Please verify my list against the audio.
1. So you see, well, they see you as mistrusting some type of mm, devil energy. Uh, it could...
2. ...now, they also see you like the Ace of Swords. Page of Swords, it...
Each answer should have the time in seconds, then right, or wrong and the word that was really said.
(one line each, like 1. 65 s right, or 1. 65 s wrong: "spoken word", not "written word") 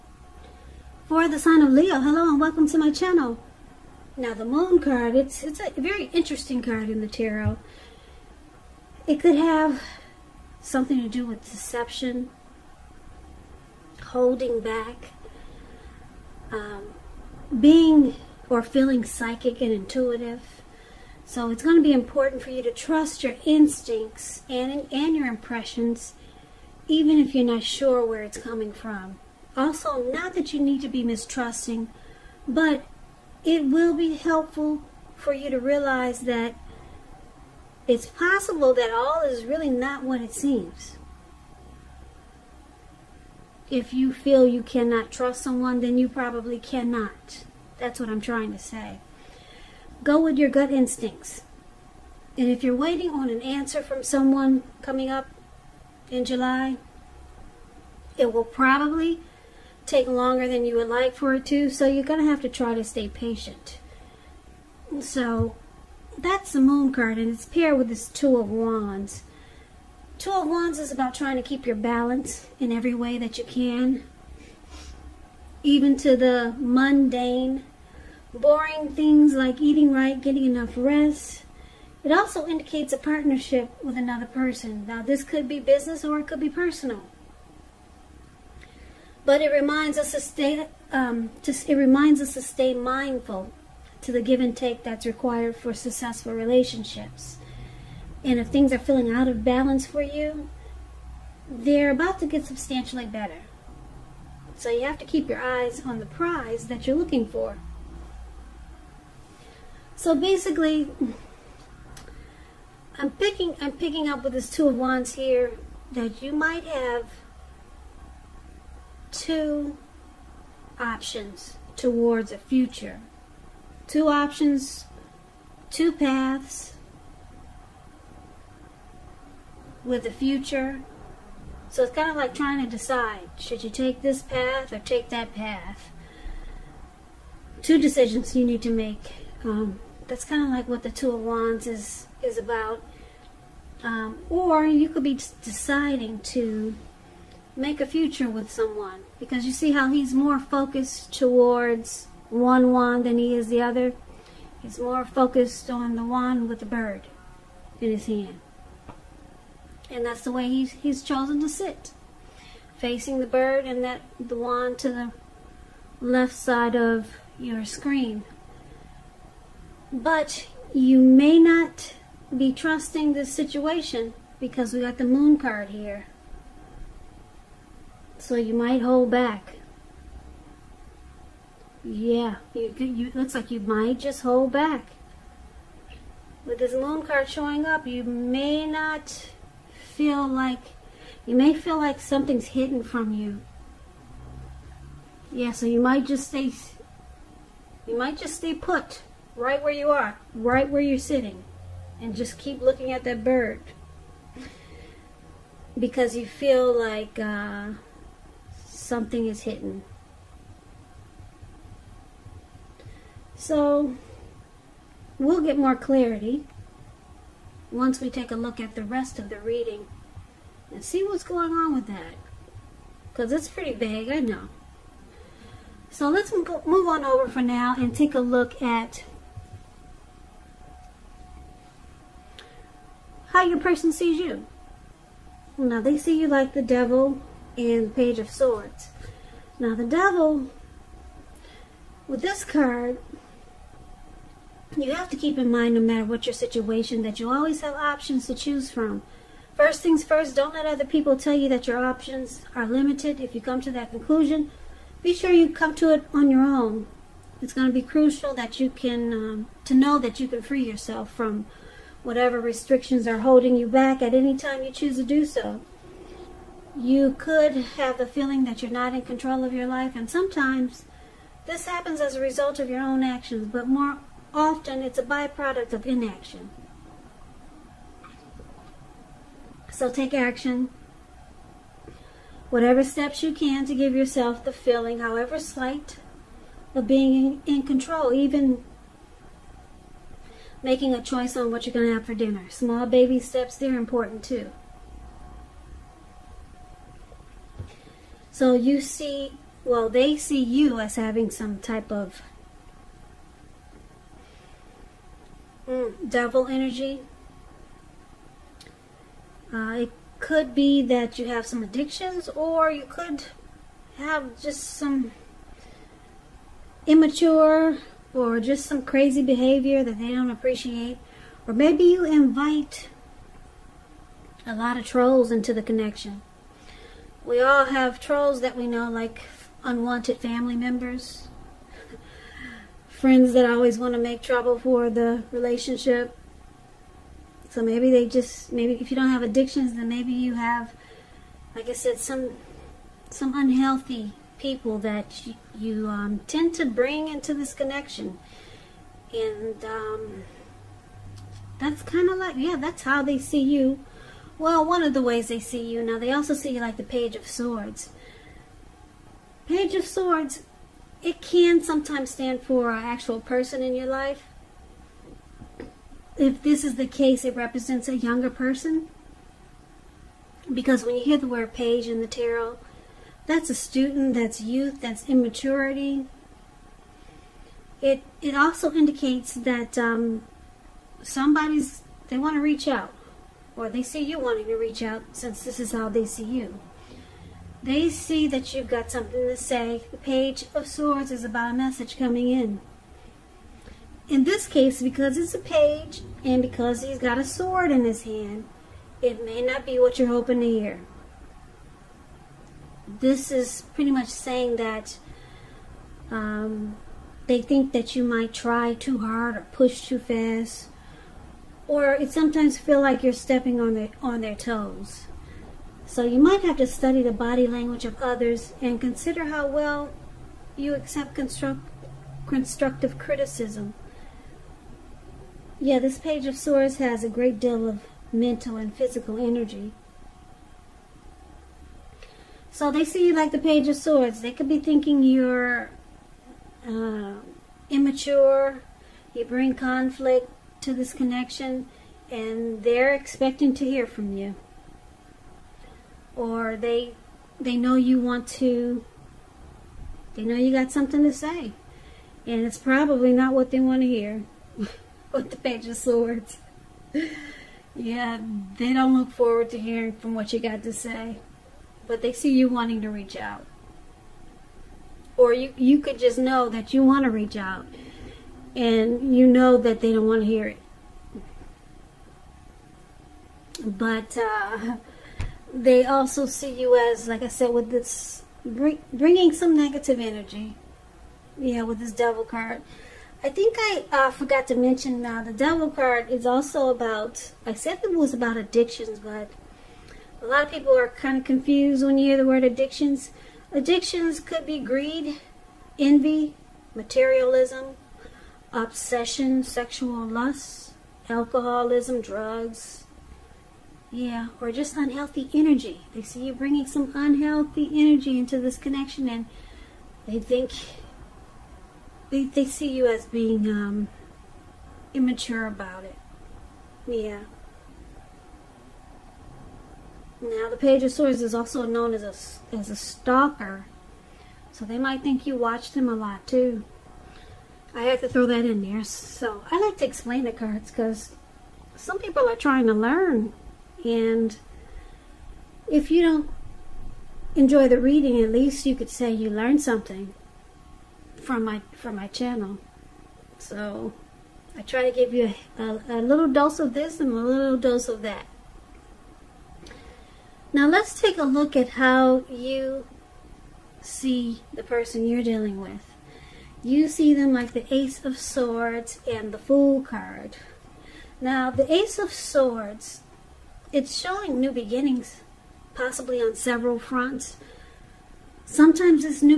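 1. 298 s wrong: "having", not "mistrusting"
2. 355 s wrong: "Page", not "Ace".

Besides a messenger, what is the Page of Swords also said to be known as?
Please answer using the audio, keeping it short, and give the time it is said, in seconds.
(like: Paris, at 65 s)
A stalker, at 522 s.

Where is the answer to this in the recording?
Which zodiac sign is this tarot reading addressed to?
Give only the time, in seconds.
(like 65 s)
1 s.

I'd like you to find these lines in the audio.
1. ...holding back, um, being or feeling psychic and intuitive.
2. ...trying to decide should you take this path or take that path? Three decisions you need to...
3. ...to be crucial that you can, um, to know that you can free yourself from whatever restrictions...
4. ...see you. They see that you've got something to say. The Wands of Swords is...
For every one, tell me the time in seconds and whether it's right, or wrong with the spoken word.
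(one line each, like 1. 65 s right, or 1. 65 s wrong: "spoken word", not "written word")
1. 14 s right
2. 132 s wrong: "Two", not "Three"
3. 257 s right
4. 386 s wrong: "Page", not "Wands".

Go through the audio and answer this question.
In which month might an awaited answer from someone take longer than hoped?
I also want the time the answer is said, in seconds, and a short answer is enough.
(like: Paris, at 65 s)
July, at 56 s.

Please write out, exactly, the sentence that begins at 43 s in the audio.
If you feel you cannot trust someone, then you probably cannot.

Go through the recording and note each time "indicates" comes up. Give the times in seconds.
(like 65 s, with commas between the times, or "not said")
82 s, 378 s.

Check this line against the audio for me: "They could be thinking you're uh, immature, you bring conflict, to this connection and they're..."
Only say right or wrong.
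right.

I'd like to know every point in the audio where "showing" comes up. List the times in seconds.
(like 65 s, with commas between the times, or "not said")
187 s, 564 s.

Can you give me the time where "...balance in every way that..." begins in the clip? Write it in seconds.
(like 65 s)
71 s.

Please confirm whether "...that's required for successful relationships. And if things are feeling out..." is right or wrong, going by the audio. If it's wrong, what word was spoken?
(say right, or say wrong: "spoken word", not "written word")
right.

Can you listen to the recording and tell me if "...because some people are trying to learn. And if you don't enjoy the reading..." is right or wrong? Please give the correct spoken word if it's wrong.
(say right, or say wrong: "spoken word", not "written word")
right.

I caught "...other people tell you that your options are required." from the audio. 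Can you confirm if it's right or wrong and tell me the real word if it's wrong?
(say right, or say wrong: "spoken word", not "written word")
wrong: "limited", not "required".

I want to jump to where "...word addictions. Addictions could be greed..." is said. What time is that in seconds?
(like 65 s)
492 s.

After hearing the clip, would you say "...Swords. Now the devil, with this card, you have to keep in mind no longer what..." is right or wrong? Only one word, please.
wrong.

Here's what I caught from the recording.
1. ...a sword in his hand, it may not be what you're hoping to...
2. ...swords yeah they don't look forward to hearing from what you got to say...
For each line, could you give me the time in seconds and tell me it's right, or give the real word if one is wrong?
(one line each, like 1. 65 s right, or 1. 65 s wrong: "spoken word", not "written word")
1. 397 s right
2. 455 s right.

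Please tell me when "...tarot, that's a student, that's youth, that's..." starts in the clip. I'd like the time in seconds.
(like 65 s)
372 s.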